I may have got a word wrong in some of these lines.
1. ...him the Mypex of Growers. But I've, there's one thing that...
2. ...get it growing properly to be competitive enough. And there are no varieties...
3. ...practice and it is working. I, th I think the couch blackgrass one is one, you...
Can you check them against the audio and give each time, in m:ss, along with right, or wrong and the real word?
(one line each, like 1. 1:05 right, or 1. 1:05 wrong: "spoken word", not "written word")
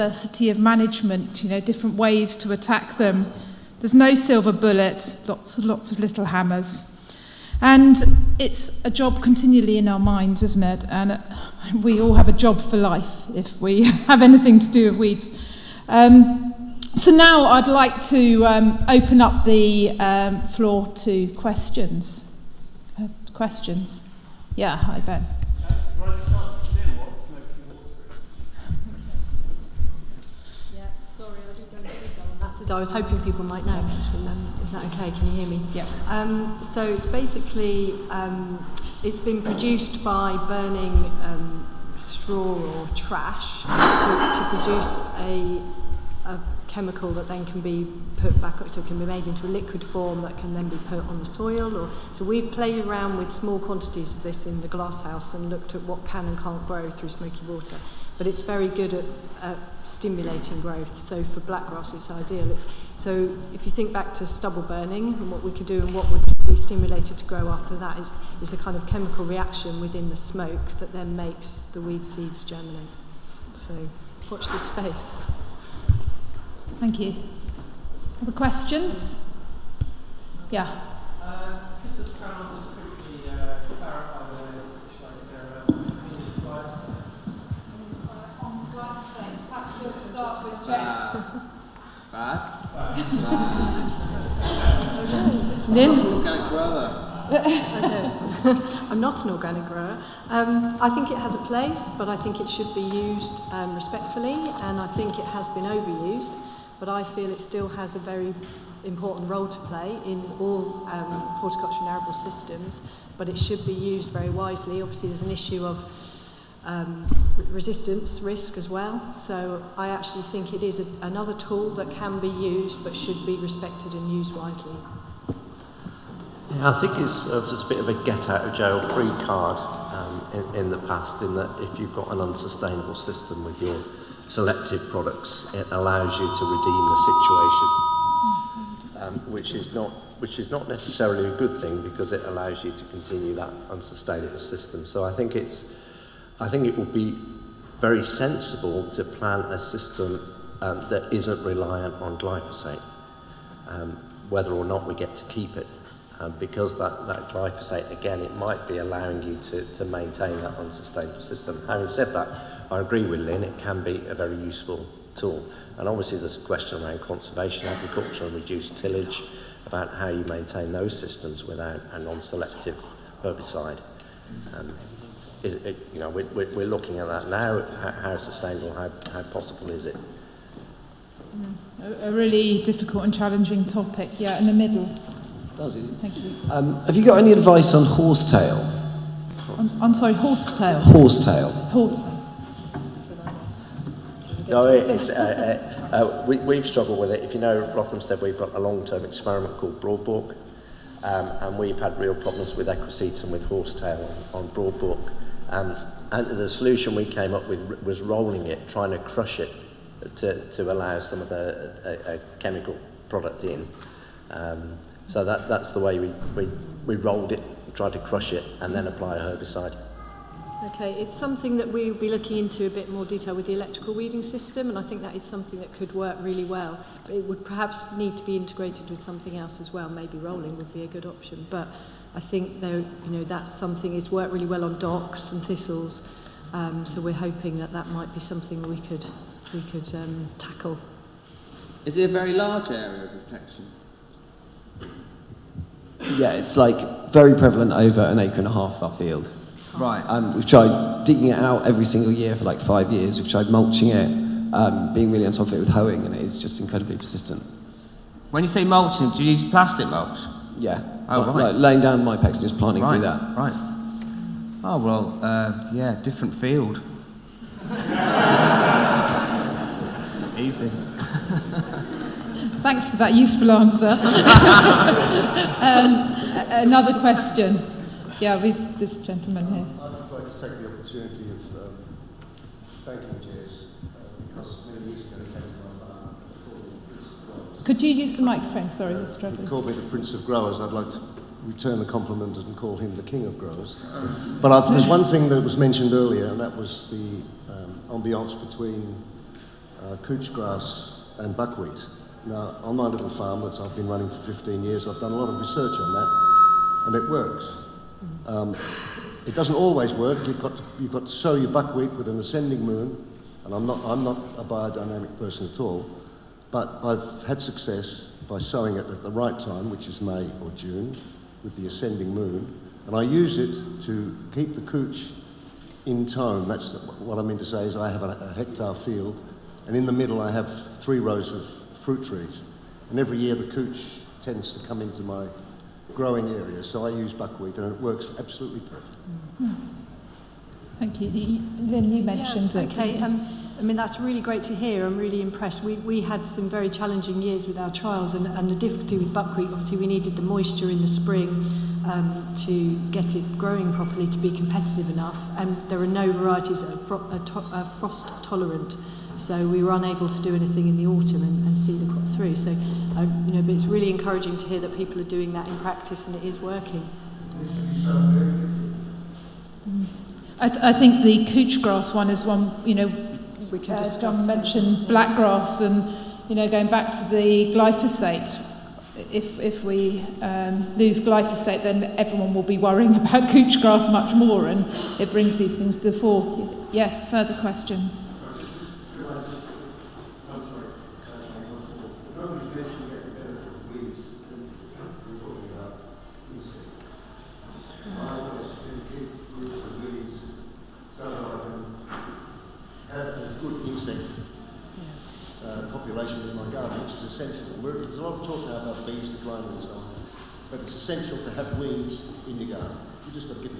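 1. 4:52 wrong: "King", not "Mypex"
2. 5:52 right
3. 6:05 wrong: "grass", not "blackgrass".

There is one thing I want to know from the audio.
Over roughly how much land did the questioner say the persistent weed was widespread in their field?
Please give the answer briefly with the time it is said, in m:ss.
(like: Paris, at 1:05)
An acre and a half, at 4:07.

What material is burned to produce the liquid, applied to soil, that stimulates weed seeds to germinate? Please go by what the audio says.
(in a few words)
Straw or trash.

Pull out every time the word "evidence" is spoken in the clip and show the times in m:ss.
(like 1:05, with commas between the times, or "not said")
not said.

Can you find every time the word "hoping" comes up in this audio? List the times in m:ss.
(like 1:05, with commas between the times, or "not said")
0:32, 3:57.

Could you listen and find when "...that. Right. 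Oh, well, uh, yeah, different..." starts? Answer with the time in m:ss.
4:23.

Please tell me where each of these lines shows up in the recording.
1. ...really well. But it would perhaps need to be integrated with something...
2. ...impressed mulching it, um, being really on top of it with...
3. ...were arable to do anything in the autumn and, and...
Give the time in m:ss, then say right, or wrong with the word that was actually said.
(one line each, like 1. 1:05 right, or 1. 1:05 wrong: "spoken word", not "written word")
1. 3:46 right
2. 4:13 wrong: "tried", not "impressed"
3. 5:59 wrong: "unable", not "arable".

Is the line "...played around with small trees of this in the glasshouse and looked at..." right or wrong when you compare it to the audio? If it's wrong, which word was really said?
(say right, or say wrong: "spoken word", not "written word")
wrong: "quantities", not "trees".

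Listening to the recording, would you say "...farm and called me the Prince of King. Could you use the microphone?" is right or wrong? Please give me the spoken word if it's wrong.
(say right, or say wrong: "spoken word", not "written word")
wrong: "Growers", not "King".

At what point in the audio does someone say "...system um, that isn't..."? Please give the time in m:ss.
2:29.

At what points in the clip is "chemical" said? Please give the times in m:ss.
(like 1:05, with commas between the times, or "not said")
0:46, 1:08, 3:32.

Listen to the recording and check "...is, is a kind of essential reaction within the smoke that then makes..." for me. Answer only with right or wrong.
wrong.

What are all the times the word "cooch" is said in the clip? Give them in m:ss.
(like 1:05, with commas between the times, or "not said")
5:24, 5:33.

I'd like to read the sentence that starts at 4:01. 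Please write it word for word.
Is it a very large area of protection?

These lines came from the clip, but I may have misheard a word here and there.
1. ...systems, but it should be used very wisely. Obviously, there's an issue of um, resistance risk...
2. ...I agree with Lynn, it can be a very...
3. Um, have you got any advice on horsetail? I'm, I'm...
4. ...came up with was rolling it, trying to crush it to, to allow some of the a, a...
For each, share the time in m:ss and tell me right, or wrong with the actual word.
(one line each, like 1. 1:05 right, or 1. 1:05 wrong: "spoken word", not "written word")
1. 1:52 right
2. 2:42 right
3. 3:06 right
4. 3:27 right.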